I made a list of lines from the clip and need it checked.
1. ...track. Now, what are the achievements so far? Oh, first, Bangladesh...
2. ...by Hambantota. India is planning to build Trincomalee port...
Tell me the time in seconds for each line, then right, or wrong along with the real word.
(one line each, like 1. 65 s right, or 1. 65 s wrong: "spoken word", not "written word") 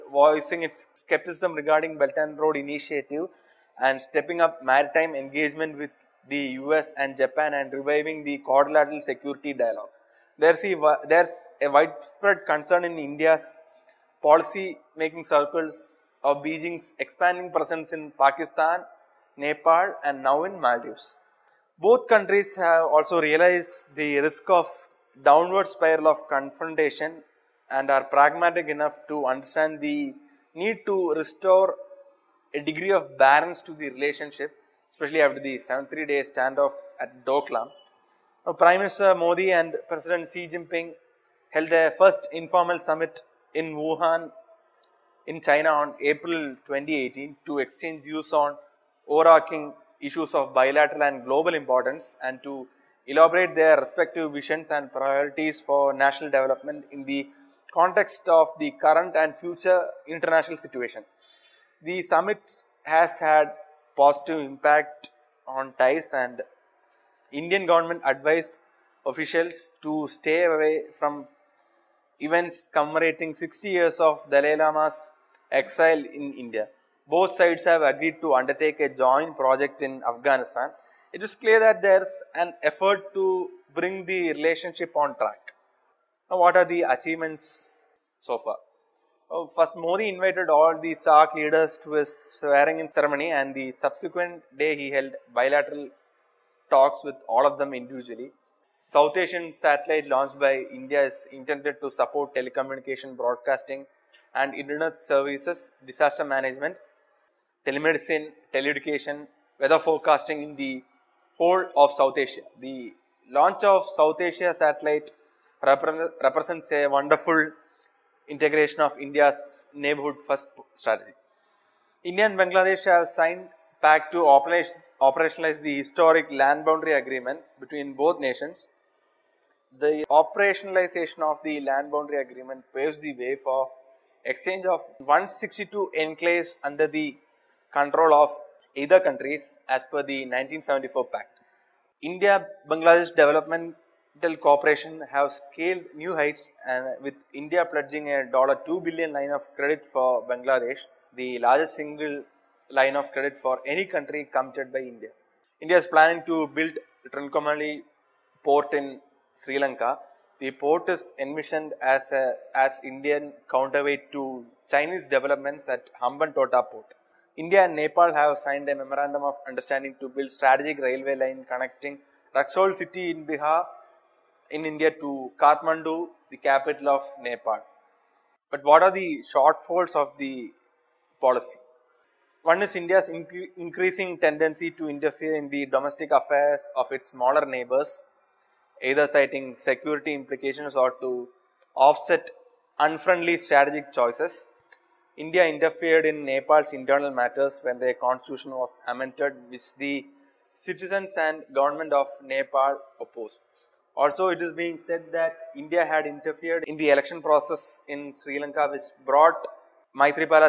1. 85 s wrong: "Modi", not "Bangladesh"
2. 154 s wrong: "India", not "Hambantota".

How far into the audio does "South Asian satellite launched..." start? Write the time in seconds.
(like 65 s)
98 s.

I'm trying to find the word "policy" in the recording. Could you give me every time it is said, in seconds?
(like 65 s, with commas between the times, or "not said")
14 s, 181 s.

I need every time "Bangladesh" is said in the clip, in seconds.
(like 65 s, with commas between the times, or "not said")
122 s, 142 s, 150 s.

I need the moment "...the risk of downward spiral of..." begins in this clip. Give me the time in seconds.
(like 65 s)
23 s.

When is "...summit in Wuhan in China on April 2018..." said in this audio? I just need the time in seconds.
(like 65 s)
42 s.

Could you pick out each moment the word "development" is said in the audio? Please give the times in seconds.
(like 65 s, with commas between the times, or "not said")
56 s, 143 s, 165 s.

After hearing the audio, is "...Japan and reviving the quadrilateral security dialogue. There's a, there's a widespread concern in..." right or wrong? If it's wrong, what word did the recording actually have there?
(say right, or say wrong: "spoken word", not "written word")
right.